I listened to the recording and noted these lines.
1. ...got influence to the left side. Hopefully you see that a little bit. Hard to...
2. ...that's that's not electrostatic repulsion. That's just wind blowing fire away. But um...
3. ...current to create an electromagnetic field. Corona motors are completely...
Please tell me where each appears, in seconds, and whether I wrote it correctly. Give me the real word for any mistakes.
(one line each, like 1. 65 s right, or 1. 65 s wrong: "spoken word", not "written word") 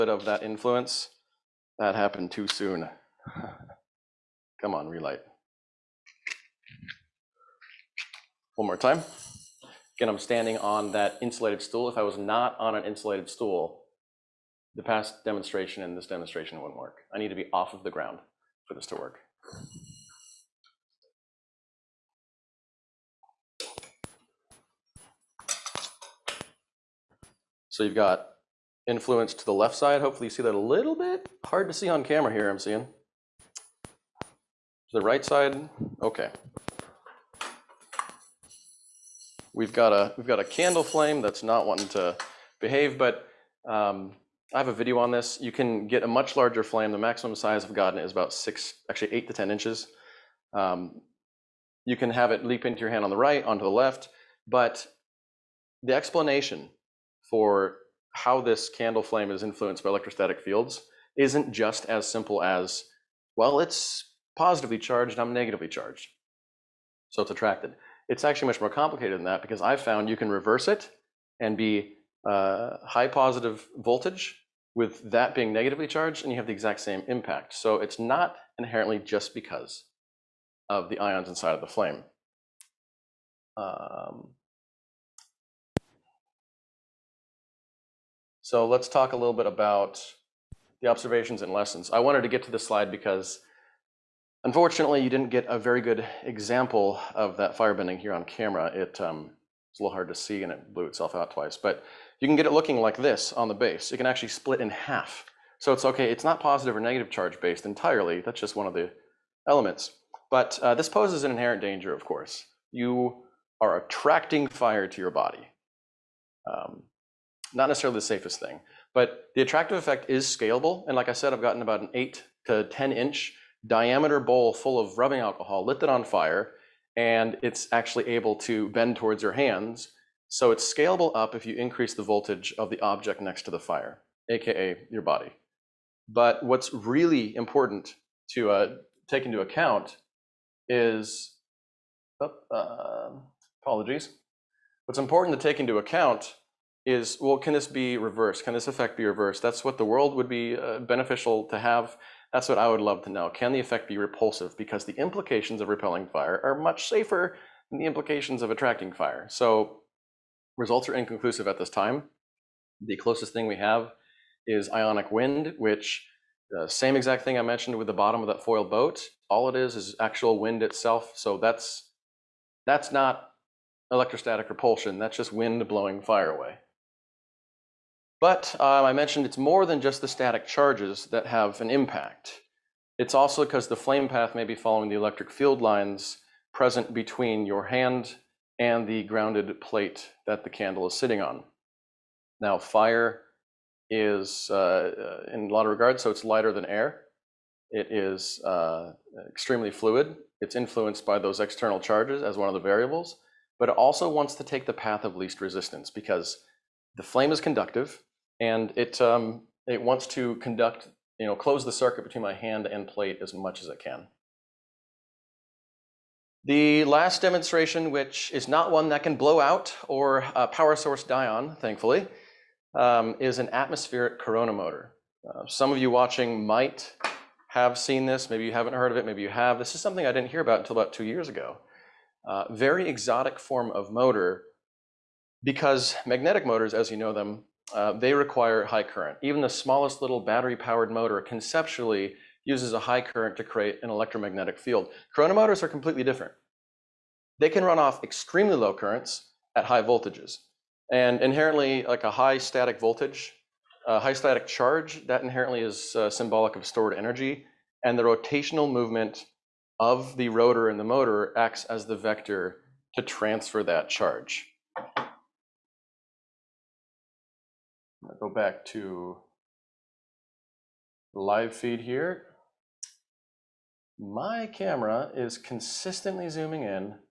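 1. 27 s right
2. 171 s right
3. 243 s right.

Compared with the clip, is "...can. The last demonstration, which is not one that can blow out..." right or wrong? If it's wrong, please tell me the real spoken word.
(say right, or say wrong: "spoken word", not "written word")
right.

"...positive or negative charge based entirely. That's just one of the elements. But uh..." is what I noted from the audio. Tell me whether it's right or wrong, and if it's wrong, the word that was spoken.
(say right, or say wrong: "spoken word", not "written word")
right.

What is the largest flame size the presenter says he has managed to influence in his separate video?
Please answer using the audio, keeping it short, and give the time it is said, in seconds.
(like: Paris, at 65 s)
8 to 10 inches, at 49 s.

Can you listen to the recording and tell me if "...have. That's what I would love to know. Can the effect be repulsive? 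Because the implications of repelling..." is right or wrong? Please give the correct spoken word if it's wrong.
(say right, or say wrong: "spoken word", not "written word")
right.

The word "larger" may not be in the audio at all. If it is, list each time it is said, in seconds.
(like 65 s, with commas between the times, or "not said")
46 s.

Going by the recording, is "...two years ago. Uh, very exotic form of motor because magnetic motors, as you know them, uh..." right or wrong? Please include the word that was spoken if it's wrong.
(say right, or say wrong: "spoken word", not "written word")
right.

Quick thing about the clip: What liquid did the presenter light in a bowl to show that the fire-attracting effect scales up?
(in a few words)
Rubbing alcohol.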